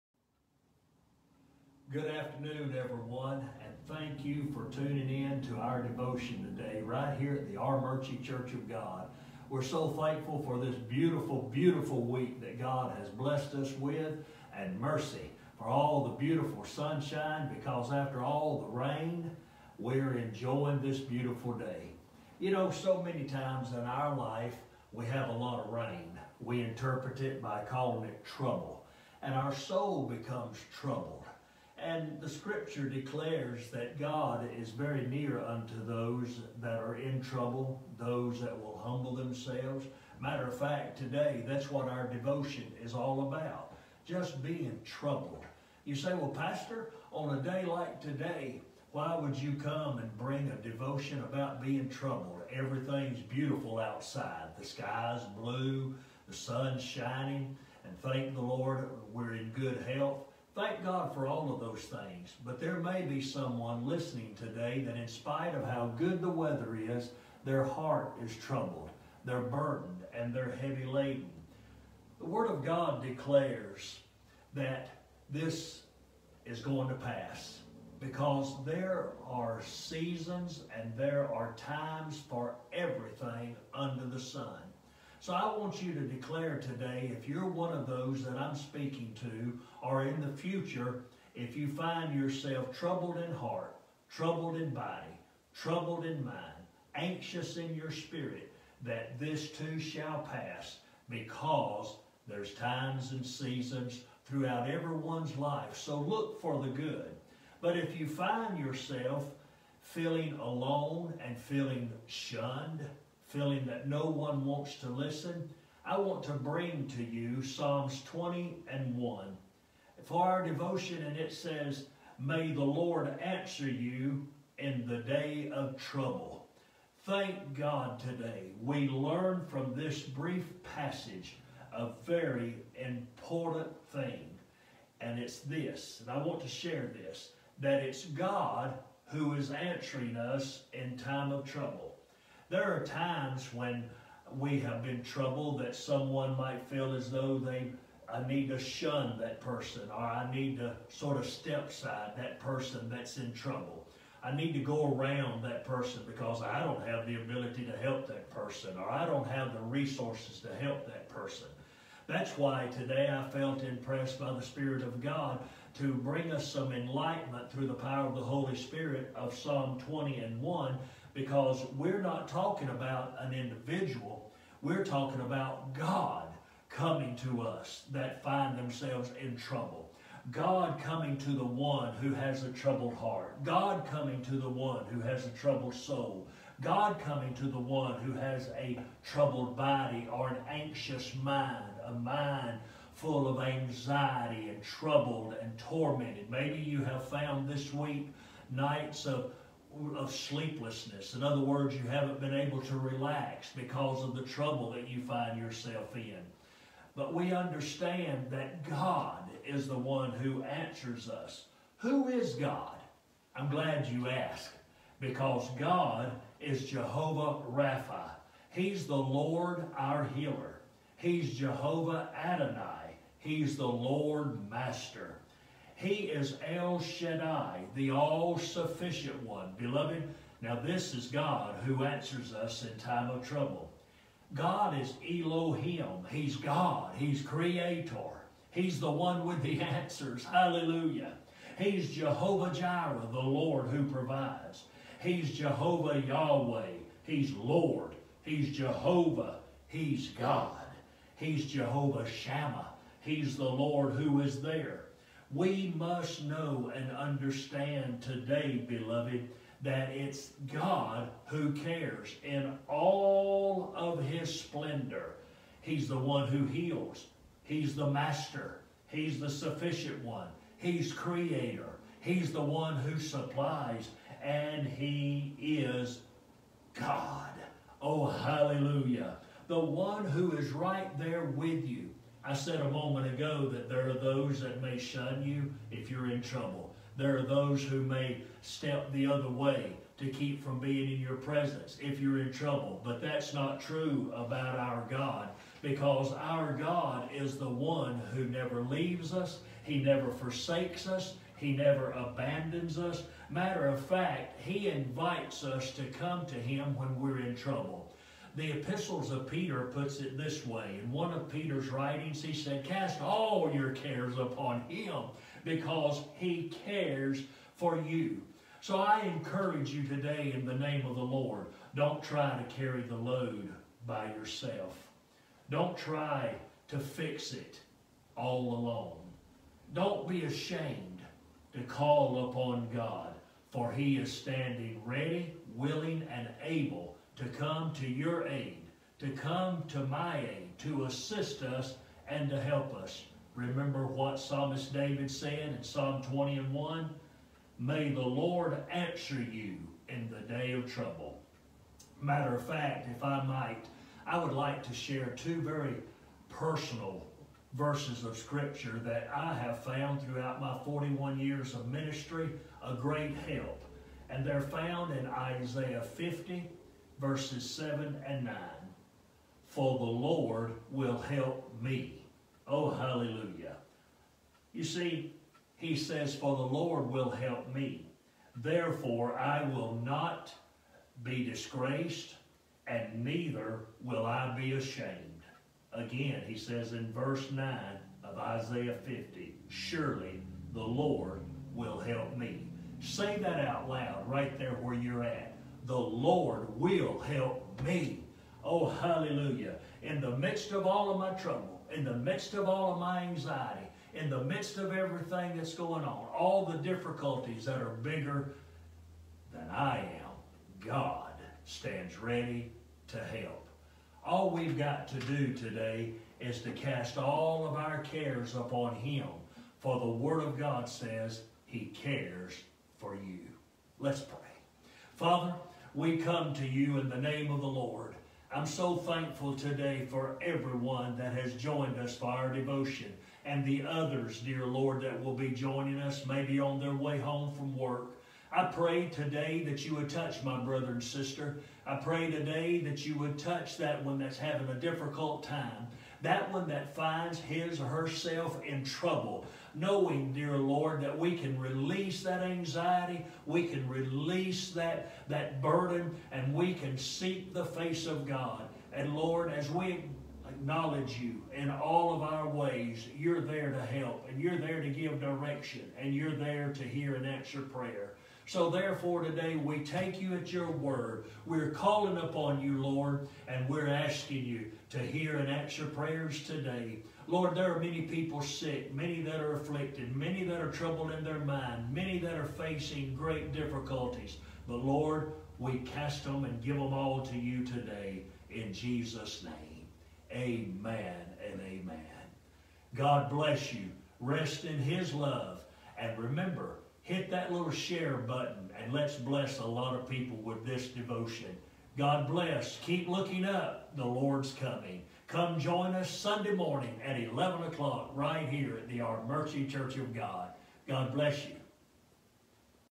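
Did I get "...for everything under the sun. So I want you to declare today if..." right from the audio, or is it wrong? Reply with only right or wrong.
right.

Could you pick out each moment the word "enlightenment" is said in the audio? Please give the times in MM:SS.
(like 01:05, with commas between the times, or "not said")
02:46.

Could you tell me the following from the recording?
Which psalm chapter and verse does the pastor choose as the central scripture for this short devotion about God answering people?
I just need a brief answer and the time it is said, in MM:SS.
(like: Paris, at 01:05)
Psalms 20:1, at 01:57.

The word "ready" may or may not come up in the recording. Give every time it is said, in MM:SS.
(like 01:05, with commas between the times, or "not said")
05:34, 06:51.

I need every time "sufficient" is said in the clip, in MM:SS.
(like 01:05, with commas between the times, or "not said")
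03:48, 04:29.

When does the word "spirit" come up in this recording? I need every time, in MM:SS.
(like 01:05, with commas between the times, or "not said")
01:37, 02:44, 02:48.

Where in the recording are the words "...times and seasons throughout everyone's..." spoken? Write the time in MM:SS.
01:42.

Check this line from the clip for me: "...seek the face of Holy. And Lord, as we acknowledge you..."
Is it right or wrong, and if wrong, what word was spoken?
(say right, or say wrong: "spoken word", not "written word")
wrong: "God", not "Holy".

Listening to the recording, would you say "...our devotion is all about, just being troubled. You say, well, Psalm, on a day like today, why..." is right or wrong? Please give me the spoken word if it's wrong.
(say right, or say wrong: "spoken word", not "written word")
wrong: "Pastor", not "Psalm".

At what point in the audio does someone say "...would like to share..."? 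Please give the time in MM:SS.
05:54.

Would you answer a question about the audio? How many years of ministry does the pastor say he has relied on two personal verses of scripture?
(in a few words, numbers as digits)
41.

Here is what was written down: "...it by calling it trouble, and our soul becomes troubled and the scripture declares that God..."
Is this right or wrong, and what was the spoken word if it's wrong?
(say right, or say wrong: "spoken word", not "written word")
right.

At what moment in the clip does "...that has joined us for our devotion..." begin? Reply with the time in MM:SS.
07:10.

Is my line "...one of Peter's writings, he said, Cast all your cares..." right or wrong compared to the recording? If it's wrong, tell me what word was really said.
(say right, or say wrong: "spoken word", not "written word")
right.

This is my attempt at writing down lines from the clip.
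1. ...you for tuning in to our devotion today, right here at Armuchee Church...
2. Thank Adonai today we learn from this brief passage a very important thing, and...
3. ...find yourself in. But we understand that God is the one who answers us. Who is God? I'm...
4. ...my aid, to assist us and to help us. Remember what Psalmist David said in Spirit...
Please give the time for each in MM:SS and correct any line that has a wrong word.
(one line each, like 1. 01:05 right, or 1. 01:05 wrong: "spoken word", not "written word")
1. 00:04 right
2. 02:07 wrong: "God", not "Adonai"
3. 03:25 right
4. 05:39 wrong: "Psalm", not "Spirit".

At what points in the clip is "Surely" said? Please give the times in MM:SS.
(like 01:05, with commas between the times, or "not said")
06:29.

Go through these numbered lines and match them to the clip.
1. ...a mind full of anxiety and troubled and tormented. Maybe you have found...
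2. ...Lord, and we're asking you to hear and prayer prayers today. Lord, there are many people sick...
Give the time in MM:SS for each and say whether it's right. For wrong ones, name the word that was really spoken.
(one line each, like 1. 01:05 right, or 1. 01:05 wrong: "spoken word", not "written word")
1. 03:11 right
2. 07:52 wrong: "answer", not "prayer".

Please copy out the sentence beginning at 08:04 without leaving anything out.
But Lord, we cast them and give them all to you today in Jesus' name.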